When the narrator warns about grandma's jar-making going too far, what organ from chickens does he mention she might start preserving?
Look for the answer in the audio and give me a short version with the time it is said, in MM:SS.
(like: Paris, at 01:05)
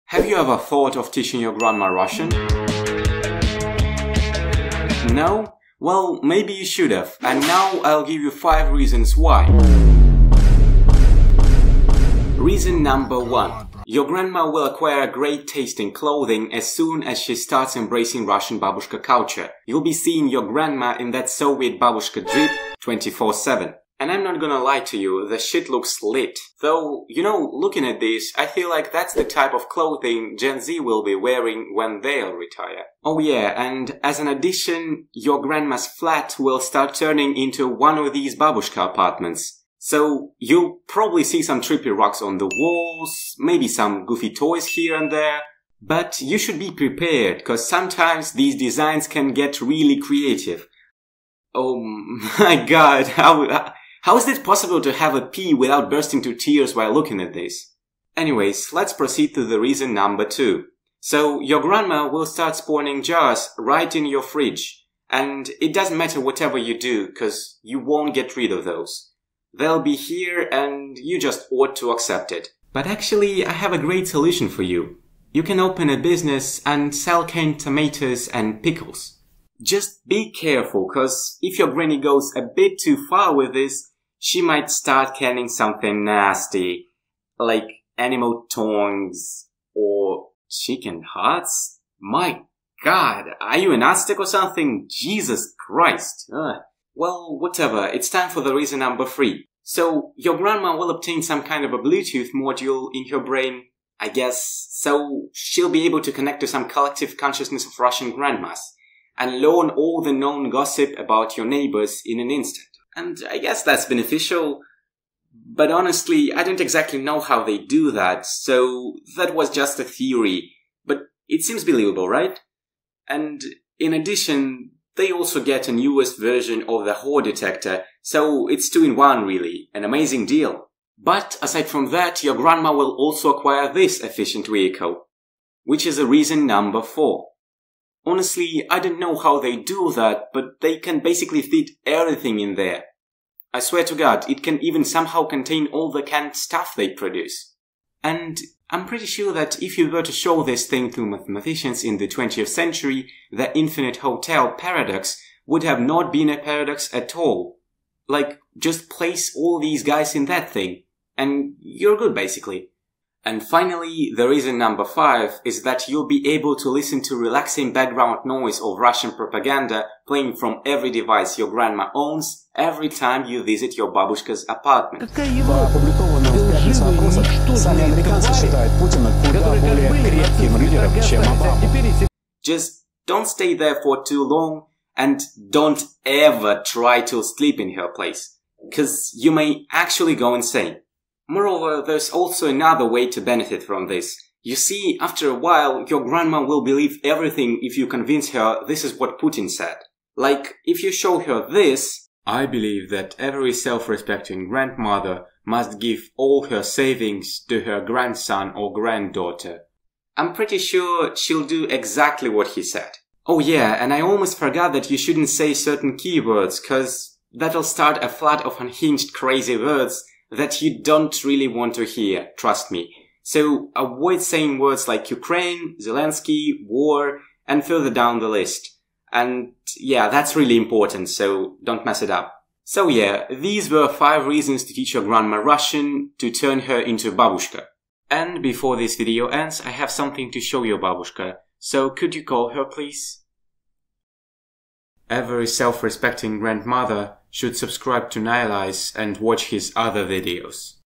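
chicken hearts, at 01:30.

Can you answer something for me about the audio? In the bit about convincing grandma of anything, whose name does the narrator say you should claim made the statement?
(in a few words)
Putin.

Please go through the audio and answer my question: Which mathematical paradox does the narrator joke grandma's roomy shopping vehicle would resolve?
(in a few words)
infinite hotel paradox.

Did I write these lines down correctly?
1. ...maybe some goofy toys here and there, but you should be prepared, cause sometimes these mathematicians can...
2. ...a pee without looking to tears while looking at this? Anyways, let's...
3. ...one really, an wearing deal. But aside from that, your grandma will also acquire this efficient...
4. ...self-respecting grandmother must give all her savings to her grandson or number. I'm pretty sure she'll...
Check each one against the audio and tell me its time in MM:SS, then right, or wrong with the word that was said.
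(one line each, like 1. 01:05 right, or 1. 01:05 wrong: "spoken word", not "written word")
1. 00:43 wrong: "designs", not "mathematicians"
2. 00:55 wrong: "bursting", not "looking"
3. 02:08 wrong: "amazing", not "wearing"
4. 03:23 wrong: "granddaughter", not "number".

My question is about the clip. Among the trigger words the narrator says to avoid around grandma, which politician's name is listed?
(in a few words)
Zelensky.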